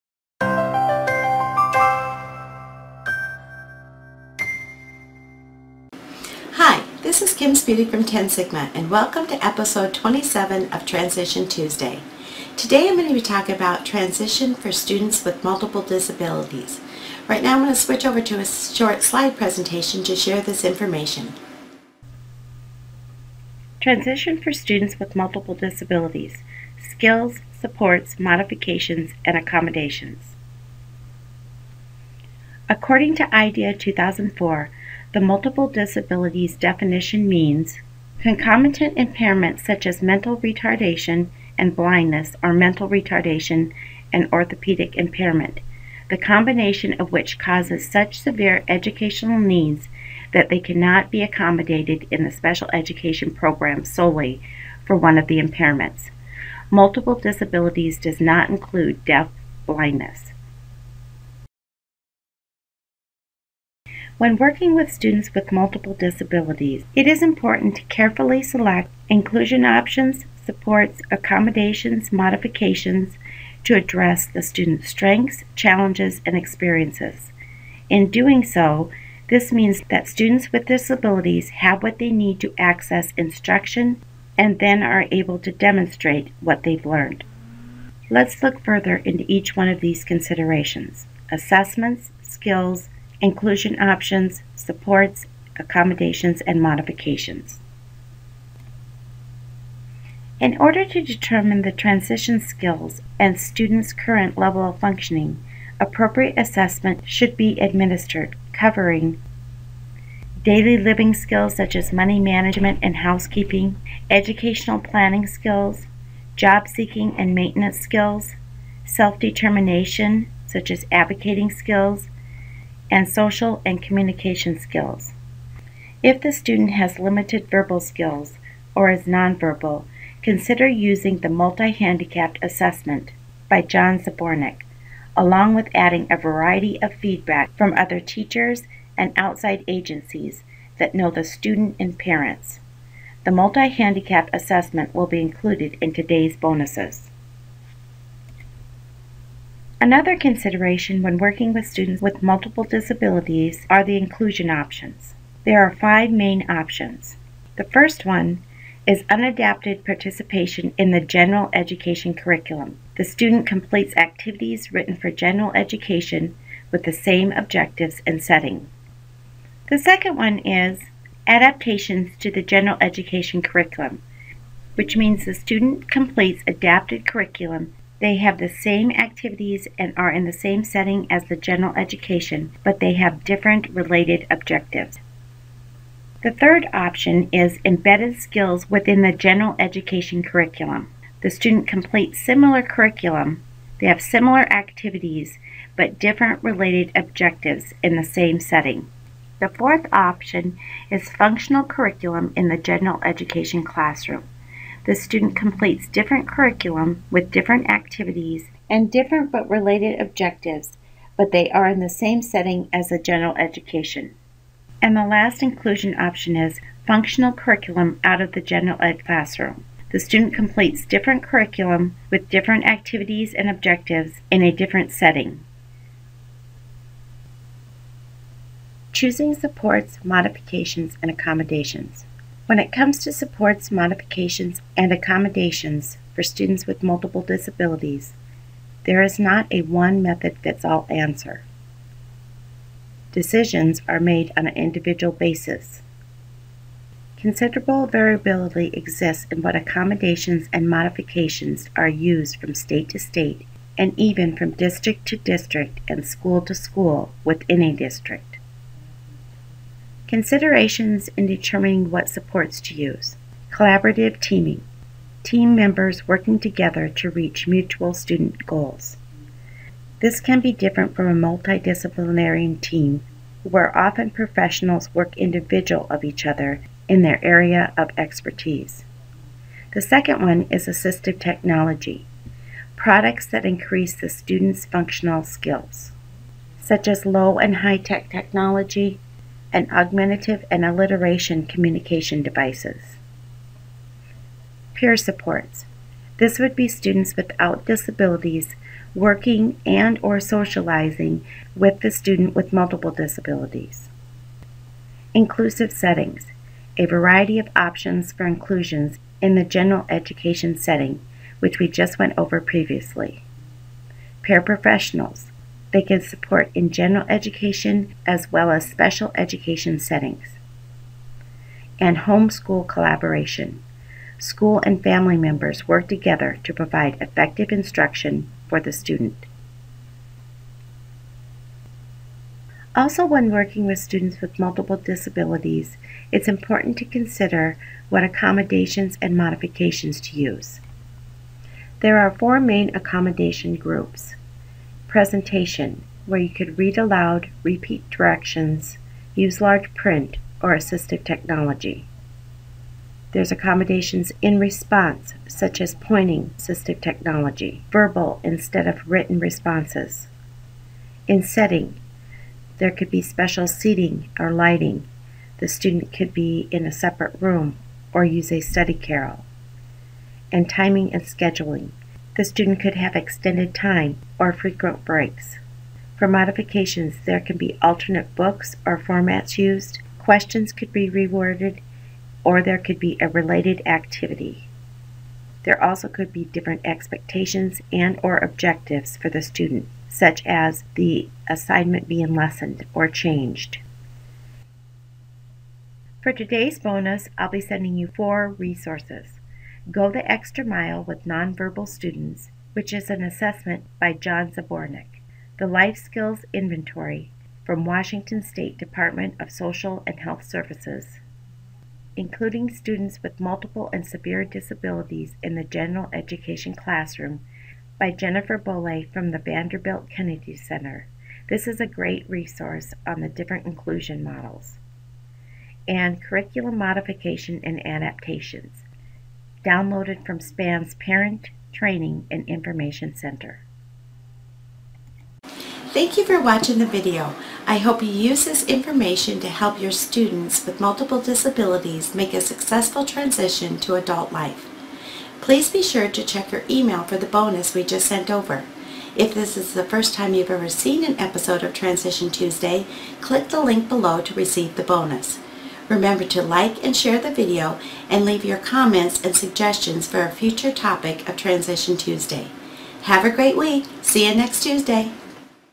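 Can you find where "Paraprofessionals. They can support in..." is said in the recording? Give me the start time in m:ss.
5:14.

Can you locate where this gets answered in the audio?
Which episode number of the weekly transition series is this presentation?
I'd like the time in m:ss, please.
0:09.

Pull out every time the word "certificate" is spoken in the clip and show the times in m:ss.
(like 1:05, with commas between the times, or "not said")
not said.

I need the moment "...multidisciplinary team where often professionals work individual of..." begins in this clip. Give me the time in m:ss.
4:31.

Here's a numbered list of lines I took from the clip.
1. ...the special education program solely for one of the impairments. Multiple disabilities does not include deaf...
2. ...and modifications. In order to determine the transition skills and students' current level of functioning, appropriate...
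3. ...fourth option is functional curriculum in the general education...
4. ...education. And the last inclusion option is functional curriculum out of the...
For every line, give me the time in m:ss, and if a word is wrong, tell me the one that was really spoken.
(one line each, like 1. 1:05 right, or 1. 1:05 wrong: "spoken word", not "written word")
1. 0:52 right
2. 1:36 right
3. 3:19 right
4. 3:33 right.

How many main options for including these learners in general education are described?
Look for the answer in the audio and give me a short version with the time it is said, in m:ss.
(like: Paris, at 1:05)
five, at 2:35.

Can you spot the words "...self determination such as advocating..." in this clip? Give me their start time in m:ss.
1:58.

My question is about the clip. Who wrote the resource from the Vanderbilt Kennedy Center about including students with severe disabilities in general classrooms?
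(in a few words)
Jennifer Bolle.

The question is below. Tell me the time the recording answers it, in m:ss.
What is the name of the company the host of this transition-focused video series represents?
0:08.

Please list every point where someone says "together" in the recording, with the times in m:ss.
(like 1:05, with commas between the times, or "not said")
4:26, 5:25.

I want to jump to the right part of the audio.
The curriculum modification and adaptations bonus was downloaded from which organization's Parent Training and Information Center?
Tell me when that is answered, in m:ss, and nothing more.
7:10.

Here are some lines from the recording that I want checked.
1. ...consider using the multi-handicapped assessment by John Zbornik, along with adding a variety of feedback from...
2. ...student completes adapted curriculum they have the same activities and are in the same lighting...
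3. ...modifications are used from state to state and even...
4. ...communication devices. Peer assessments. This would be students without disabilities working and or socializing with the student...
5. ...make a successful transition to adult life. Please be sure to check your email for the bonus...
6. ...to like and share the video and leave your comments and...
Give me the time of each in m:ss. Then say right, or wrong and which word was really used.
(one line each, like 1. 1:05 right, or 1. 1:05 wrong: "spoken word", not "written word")
1. 2:10 right
2. 2:55 wrong: "setting", not "lighting"
3. 4:10 right
4. 4:51 wrong: "supports", not "assessments"
5. 7:21 right
6. 7:36 right.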